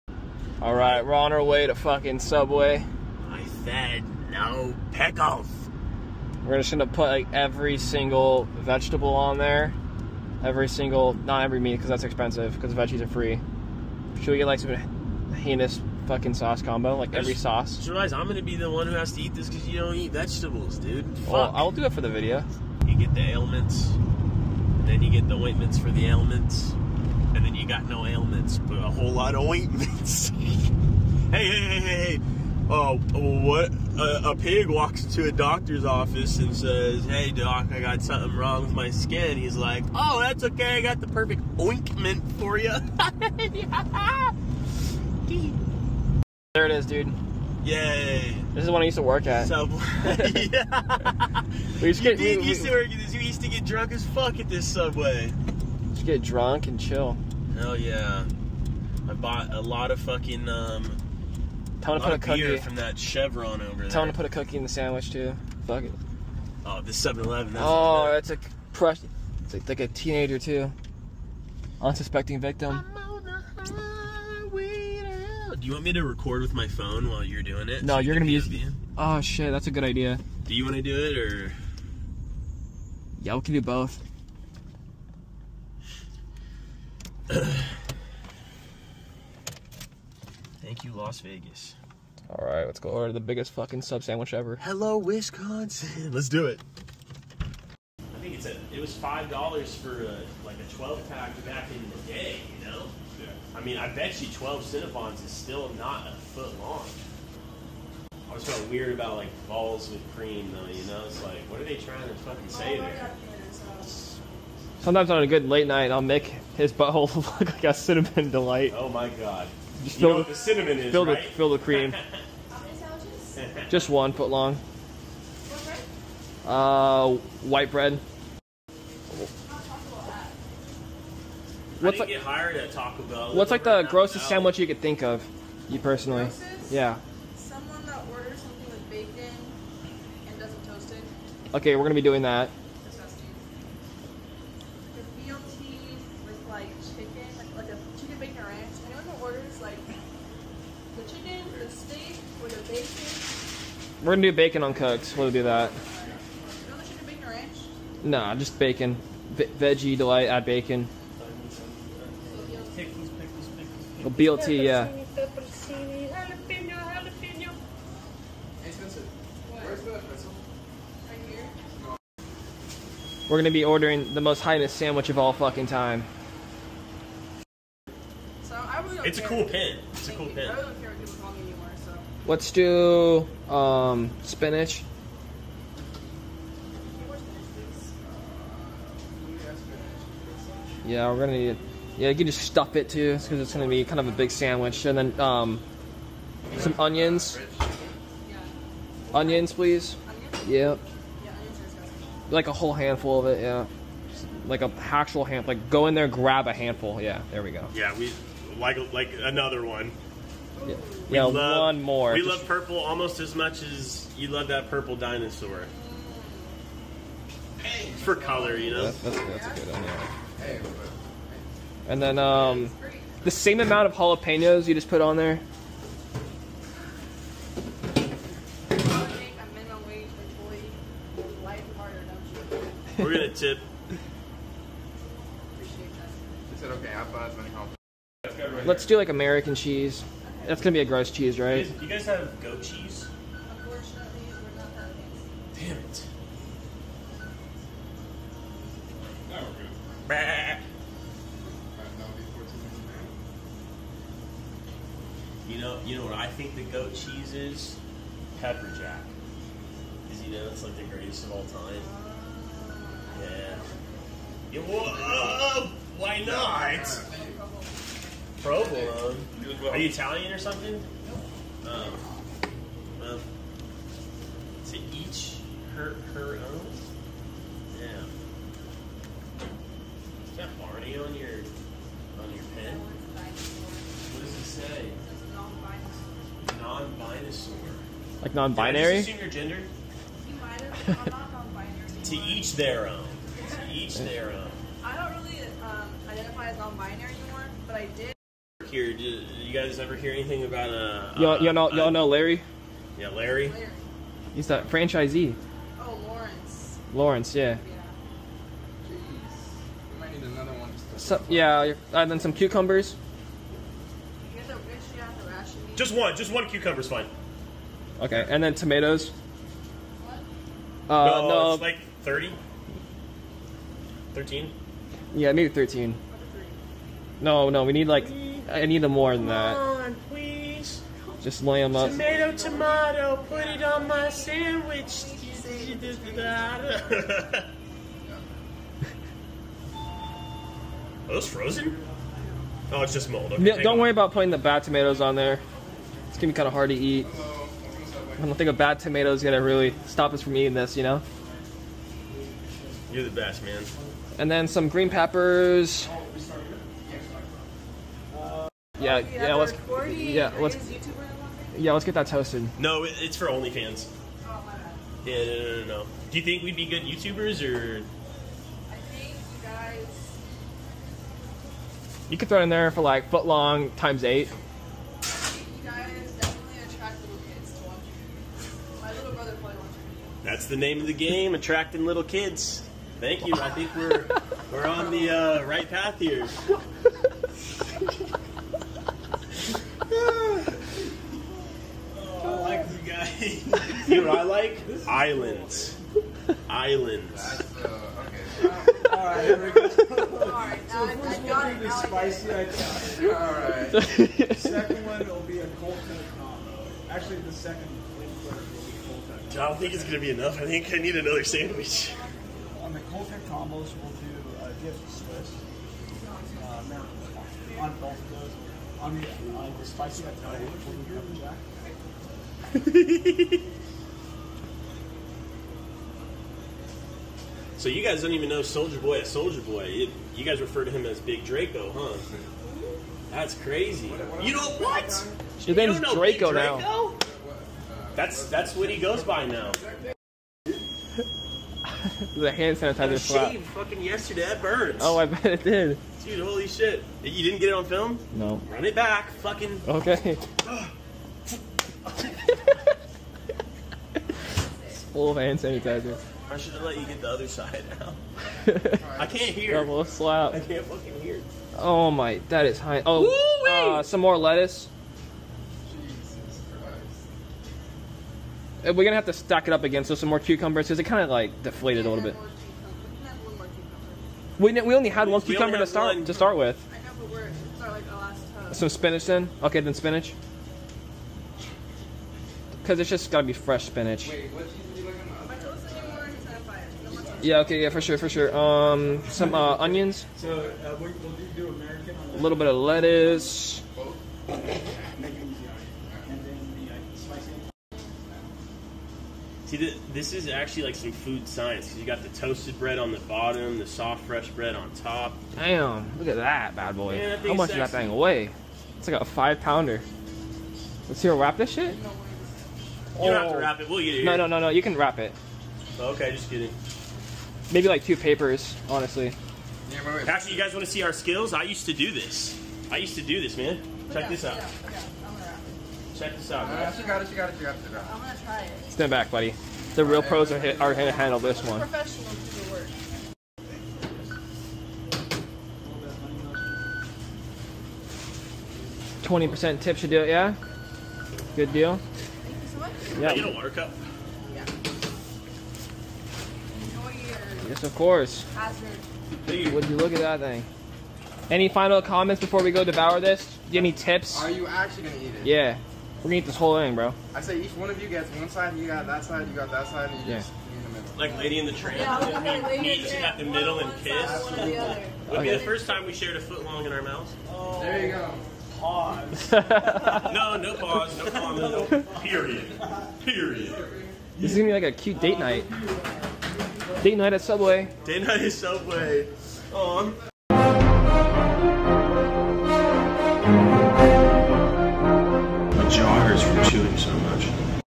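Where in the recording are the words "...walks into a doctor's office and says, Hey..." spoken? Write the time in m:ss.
0:34.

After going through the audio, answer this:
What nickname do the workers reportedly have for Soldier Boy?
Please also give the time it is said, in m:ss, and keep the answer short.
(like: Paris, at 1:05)
Big Draco, at 7:10.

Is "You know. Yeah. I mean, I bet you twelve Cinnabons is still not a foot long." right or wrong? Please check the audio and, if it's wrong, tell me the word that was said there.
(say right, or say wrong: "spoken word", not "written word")
right.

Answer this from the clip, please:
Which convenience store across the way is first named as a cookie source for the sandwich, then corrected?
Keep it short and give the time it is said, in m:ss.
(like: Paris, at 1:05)
Chevron, at 1:02.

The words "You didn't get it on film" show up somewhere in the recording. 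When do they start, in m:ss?
7:27.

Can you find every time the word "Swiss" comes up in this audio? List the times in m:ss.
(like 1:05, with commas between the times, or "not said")
6:54.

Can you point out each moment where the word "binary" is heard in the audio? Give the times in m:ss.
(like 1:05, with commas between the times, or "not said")
4:48, 4:56.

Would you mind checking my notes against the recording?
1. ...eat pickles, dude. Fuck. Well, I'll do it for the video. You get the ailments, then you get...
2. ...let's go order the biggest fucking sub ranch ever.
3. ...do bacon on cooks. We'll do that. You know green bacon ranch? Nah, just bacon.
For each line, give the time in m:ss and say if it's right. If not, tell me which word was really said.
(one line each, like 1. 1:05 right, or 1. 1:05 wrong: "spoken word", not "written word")
1. 0:19 wrong: "vegetables", not "pickles"
2. 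1:32 wrong: "sandwich", not "ranch"
3. 2:34 wrong: "chicken", not "green".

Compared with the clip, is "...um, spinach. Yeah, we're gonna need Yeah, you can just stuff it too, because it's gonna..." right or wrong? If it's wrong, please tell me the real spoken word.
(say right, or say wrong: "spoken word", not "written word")
right.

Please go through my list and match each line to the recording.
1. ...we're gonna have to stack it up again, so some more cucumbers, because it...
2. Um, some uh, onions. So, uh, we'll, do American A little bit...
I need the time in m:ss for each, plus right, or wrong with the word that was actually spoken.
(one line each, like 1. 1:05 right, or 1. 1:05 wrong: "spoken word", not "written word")
1. 7:48 right
2. 8:08 right.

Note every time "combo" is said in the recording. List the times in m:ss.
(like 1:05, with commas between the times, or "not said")
0:16, 6:45, 6:53.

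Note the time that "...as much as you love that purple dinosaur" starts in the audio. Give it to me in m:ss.
3:33.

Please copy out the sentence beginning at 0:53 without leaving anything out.
You used to get drunk as fuck at this Subway.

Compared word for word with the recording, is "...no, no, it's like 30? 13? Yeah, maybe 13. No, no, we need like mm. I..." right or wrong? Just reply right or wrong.
right.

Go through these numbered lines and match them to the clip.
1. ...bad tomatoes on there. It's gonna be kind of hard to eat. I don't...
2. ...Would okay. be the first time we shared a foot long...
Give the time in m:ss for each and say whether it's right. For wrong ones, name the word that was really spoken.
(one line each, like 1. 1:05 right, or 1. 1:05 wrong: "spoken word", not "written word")
1. 5:44 right
2. 9:25 right.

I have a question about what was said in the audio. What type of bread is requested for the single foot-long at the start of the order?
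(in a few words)
White bread.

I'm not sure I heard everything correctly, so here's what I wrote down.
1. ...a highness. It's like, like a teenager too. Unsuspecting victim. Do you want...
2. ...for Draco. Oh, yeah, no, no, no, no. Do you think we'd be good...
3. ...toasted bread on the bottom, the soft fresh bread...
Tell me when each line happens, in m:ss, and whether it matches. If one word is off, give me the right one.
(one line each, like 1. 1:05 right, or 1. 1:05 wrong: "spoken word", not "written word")
1. 1:08 wrong: "press", not "highness"
2. 6:03 wrong: "OnlyFans", not "Draco"
3. 8:22 right.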